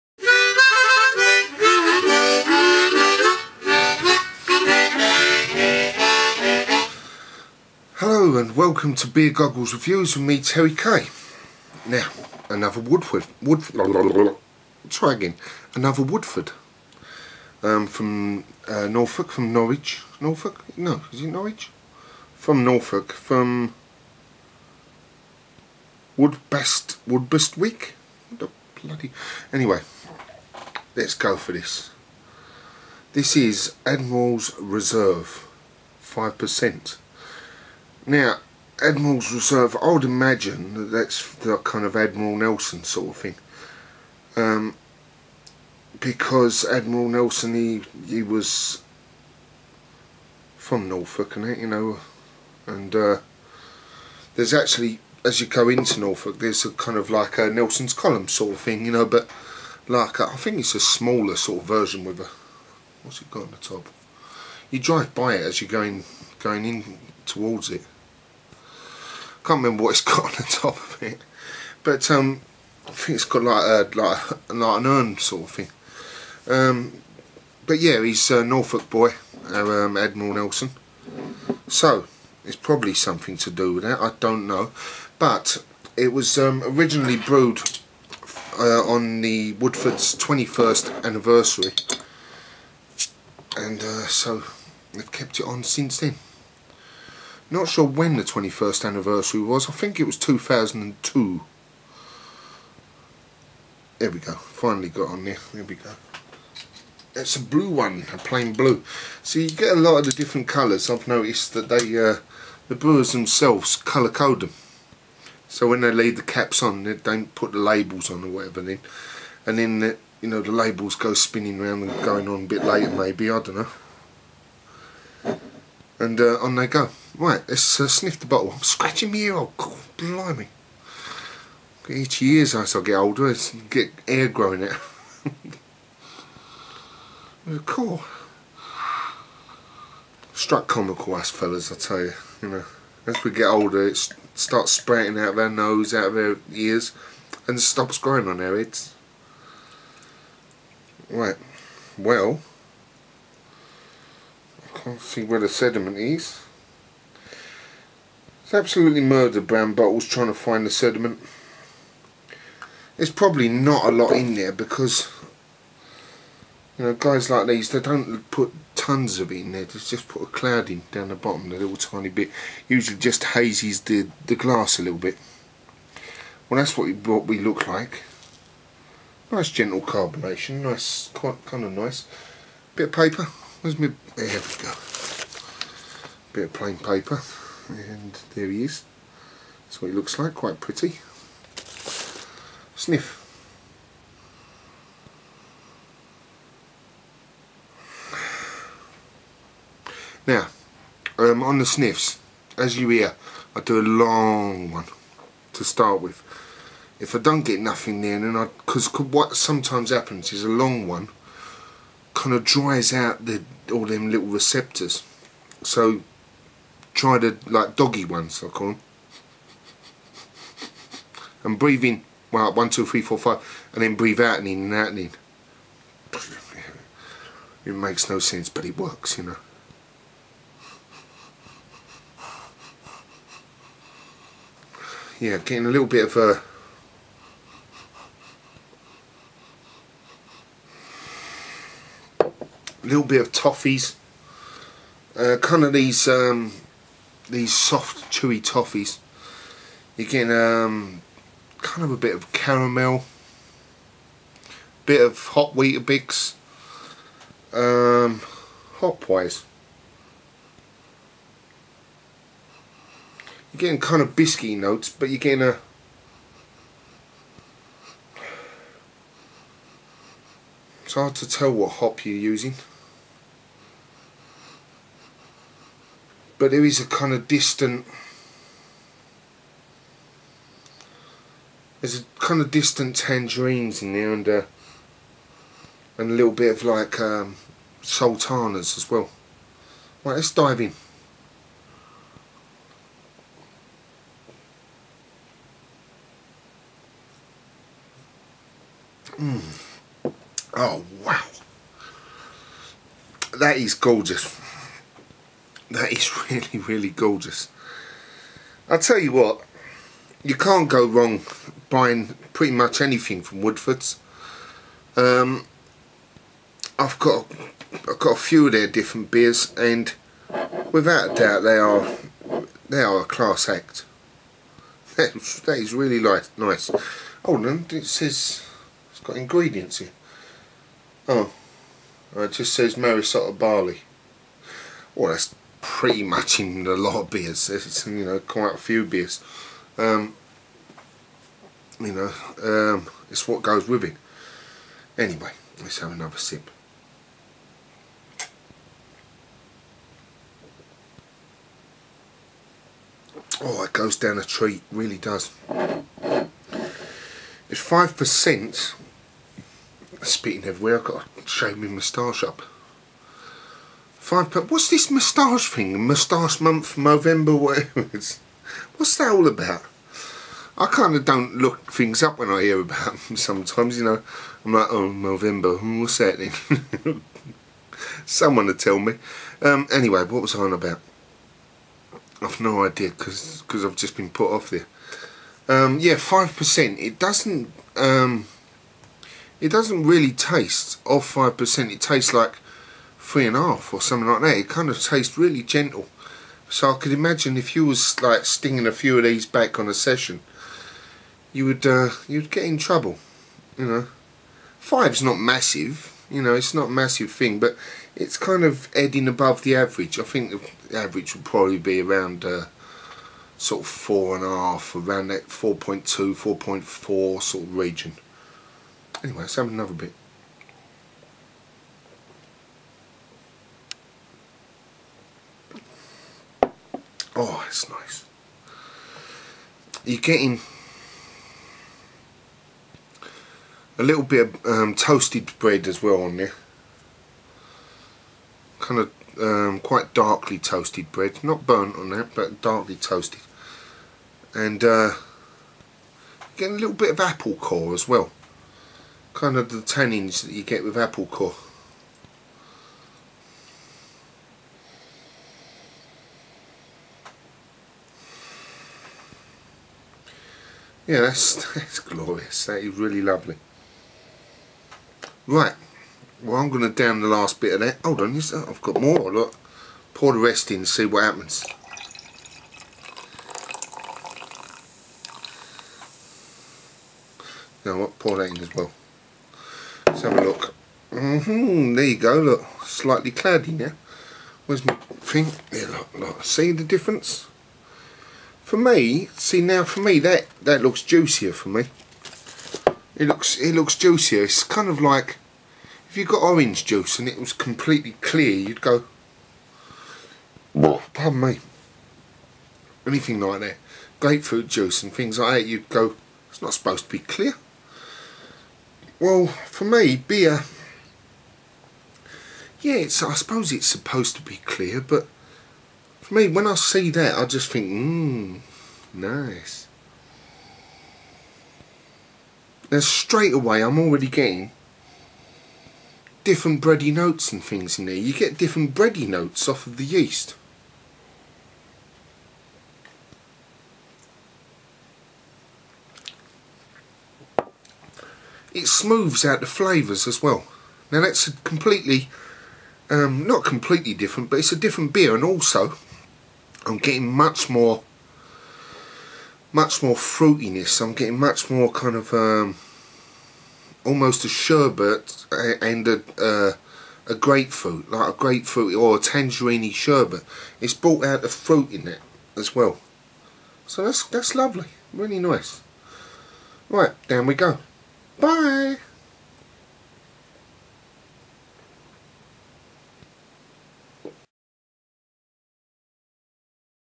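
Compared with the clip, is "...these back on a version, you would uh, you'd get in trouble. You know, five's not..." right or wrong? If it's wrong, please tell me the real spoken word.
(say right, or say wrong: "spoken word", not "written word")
wrong: "session", not "version".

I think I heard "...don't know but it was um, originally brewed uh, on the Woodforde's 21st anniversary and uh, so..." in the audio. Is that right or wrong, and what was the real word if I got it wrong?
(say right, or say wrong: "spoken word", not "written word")
right.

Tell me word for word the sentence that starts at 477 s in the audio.
You know what, pour that in as well.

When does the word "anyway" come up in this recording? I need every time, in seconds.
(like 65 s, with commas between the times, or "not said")
29 s, 344 s, 379 s, 419 s.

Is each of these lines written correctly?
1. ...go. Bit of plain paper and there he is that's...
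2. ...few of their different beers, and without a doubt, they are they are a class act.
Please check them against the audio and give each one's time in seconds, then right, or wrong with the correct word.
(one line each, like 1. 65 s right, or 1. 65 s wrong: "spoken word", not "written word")
1. 184 s right
2. 318 s right.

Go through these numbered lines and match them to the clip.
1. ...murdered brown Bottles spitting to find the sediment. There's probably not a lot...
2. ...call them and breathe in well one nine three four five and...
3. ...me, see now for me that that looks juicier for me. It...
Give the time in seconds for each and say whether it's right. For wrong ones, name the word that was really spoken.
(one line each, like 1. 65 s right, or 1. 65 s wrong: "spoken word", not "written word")
1. 158 s wrong: "trying", not "spitting"
2. 218 s wrong: "two", not "nine"
3. 488 s right.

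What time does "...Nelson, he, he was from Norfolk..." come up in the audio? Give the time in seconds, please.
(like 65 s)
47 s.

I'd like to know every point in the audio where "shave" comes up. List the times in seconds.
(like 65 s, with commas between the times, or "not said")
361 s.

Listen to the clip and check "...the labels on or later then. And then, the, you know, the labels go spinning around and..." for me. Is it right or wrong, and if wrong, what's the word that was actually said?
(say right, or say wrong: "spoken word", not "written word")
wrong: "whatever", not "later".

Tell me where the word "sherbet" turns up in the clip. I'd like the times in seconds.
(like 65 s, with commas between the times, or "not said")
554 s, 559 s.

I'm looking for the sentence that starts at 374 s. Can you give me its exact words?
I'm like, oh, November, hmm, what's that then?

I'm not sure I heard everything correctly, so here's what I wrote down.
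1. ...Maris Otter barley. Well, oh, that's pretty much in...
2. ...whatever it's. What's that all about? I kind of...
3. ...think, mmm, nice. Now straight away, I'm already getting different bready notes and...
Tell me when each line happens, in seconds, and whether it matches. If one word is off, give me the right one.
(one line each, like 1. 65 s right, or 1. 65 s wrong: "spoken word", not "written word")
1. 332 s right
2. 367 s right
3. 517 s right.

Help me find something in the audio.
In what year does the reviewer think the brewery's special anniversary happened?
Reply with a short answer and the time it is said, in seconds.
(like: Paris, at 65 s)
2002, at 100 s.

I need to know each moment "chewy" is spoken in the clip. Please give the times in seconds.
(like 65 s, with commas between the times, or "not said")
248 s.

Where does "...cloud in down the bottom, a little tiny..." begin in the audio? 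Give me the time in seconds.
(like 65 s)
170 s.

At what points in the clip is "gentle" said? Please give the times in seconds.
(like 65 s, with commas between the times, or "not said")
179 s, 395 s.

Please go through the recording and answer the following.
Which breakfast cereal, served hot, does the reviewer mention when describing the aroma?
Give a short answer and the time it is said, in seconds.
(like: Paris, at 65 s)
Weetabix, at 255 s.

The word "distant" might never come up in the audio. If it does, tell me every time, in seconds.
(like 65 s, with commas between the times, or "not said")
277 s, 282 s.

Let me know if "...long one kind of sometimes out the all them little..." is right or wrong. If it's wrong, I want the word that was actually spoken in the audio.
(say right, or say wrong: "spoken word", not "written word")
wrong: "dries", not "sometimes".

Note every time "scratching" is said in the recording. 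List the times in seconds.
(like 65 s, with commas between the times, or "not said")
128 s.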